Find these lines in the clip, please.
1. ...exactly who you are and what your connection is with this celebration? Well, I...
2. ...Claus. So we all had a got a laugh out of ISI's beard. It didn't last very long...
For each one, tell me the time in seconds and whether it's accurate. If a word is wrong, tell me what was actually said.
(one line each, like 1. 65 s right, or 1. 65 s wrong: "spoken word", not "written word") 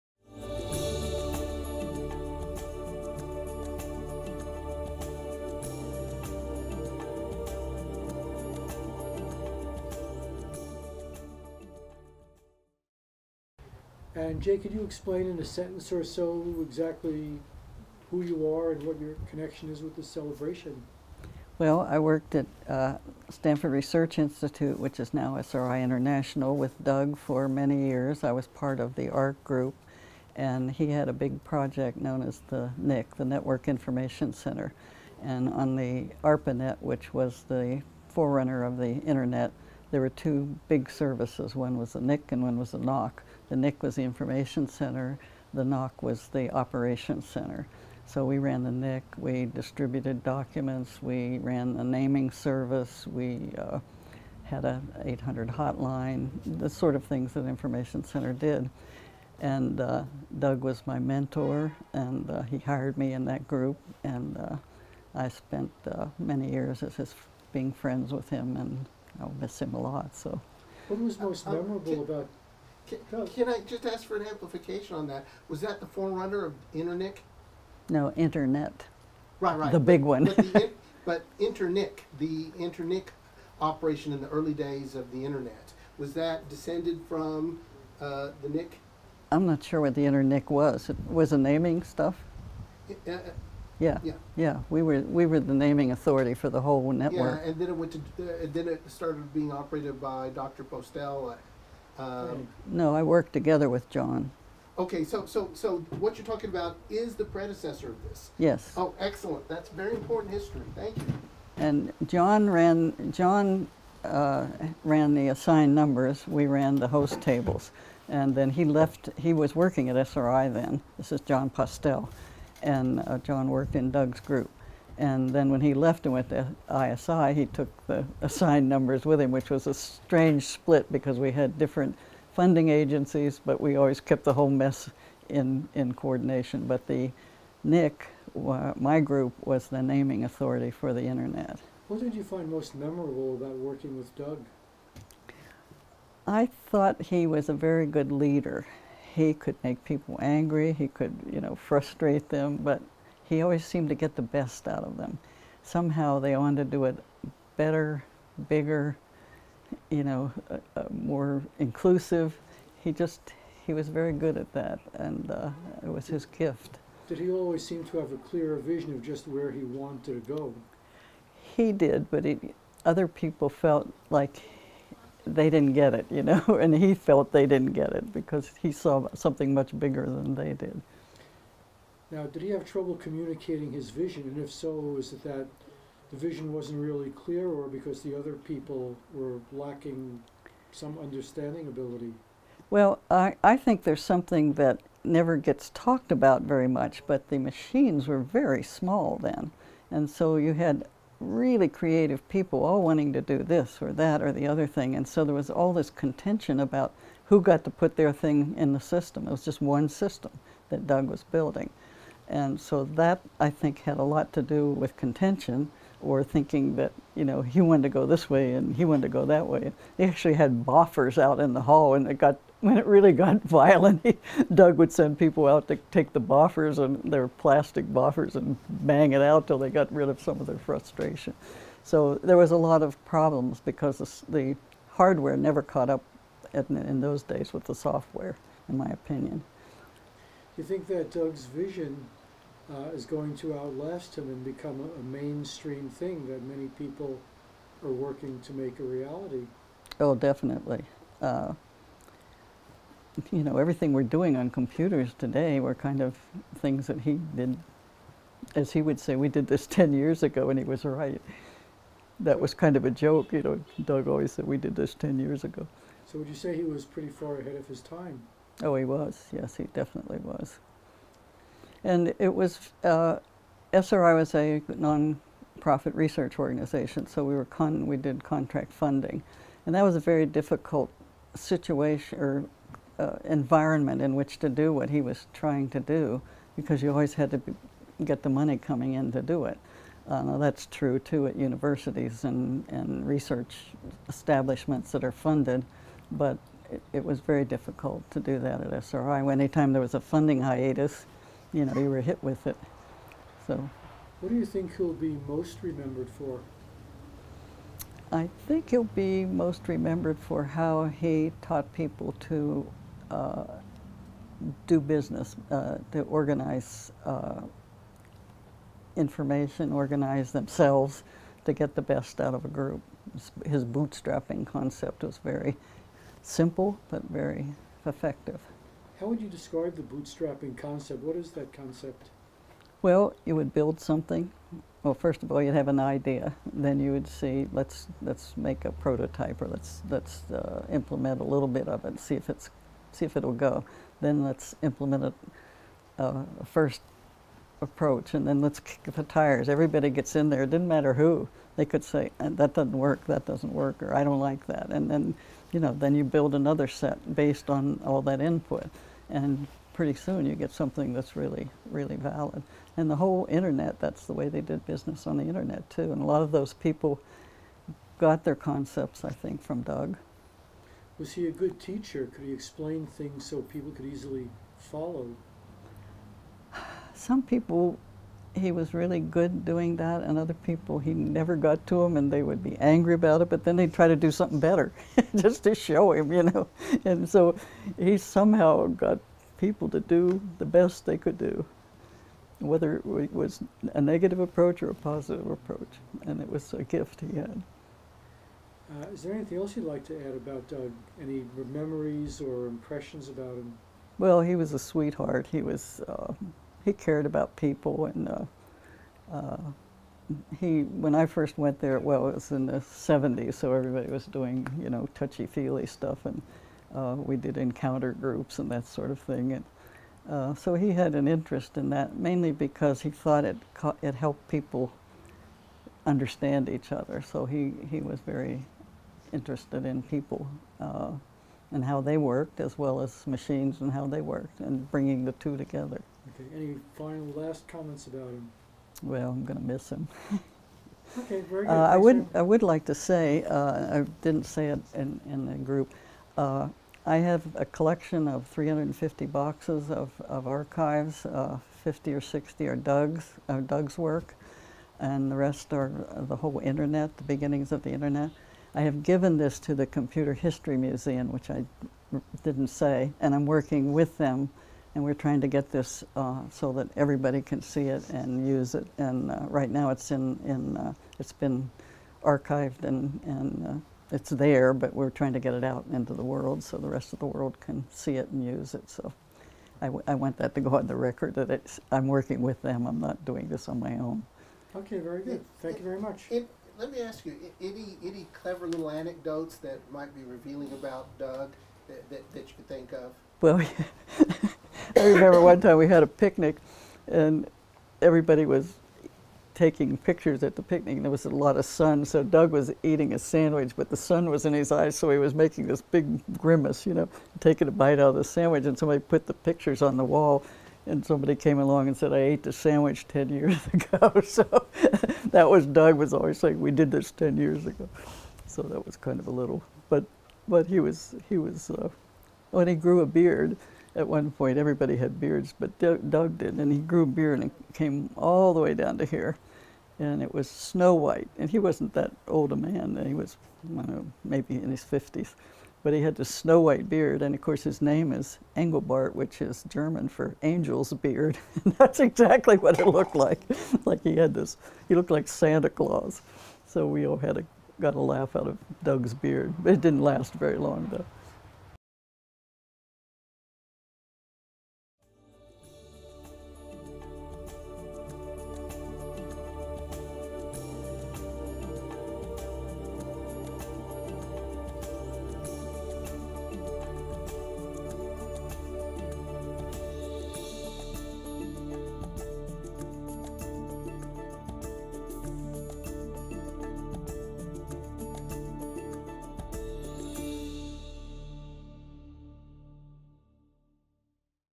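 1. 16 s right
2. 545 s wrong: "Doug", not "ISI".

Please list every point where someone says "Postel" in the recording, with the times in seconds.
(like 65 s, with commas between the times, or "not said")
100 s, 121 s.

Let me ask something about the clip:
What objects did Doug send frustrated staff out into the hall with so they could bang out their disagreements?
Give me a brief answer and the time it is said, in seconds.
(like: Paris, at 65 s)
plastic boffers, at 227 s.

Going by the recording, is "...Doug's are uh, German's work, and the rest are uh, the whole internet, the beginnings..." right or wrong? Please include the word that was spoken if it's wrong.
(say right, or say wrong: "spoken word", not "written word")
wrong: "Doug", not "German".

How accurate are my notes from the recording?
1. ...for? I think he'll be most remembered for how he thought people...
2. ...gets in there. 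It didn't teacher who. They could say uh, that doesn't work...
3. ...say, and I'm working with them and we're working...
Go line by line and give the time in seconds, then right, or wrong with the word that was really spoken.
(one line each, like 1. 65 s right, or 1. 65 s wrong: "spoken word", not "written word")
1. 306 s wrong: "taught", not "thought"
2. 349 s wrong: "matter", not "teacher"
3. 462 s wrong: "trying", not "working".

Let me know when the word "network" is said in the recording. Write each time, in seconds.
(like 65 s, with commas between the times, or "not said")
33 s, 96 s.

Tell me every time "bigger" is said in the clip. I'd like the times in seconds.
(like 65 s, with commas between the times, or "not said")
158 s, 179 s.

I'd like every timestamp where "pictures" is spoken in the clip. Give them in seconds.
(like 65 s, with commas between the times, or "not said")
499 s, 509 s.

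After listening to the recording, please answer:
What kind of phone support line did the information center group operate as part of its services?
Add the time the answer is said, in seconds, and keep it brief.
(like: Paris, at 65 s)
800 hotline, at 55 s.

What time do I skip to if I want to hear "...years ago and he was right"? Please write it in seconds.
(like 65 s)
259 s.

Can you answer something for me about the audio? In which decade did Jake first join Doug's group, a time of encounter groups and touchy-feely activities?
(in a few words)
the 70s.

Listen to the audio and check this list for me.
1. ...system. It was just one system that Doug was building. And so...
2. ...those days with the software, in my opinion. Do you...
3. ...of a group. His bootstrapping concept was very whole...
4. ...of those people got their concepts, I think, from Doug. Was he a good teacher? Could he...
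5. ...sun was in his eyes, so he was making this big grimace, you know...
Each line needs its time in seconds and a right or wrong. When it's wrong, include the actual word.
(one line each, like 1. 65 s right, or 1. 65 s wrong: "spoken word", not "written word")
1. 208 s right
2. 237 s right
3. 322 s wrong: "simple", not "whole"
4. 366 s right
5. 503 s right.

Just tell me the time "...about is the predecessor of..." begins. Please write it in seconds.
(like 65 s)
106 s.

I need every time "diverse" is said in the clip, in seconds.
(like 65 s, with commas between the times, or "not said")
not said.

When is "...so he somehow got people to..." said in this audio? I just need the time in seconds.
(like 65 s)
387 s.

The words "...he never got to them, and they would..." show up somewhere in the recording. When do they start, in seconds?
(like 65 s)
380 s.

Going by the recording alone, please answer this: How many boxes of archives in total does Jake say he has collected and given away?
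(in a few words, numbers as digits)
350.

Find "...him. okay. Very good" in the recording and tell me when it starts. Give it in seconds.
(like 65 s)
439 s.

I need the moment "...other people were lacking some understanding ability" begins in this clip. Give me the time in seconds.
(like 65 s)
188 s.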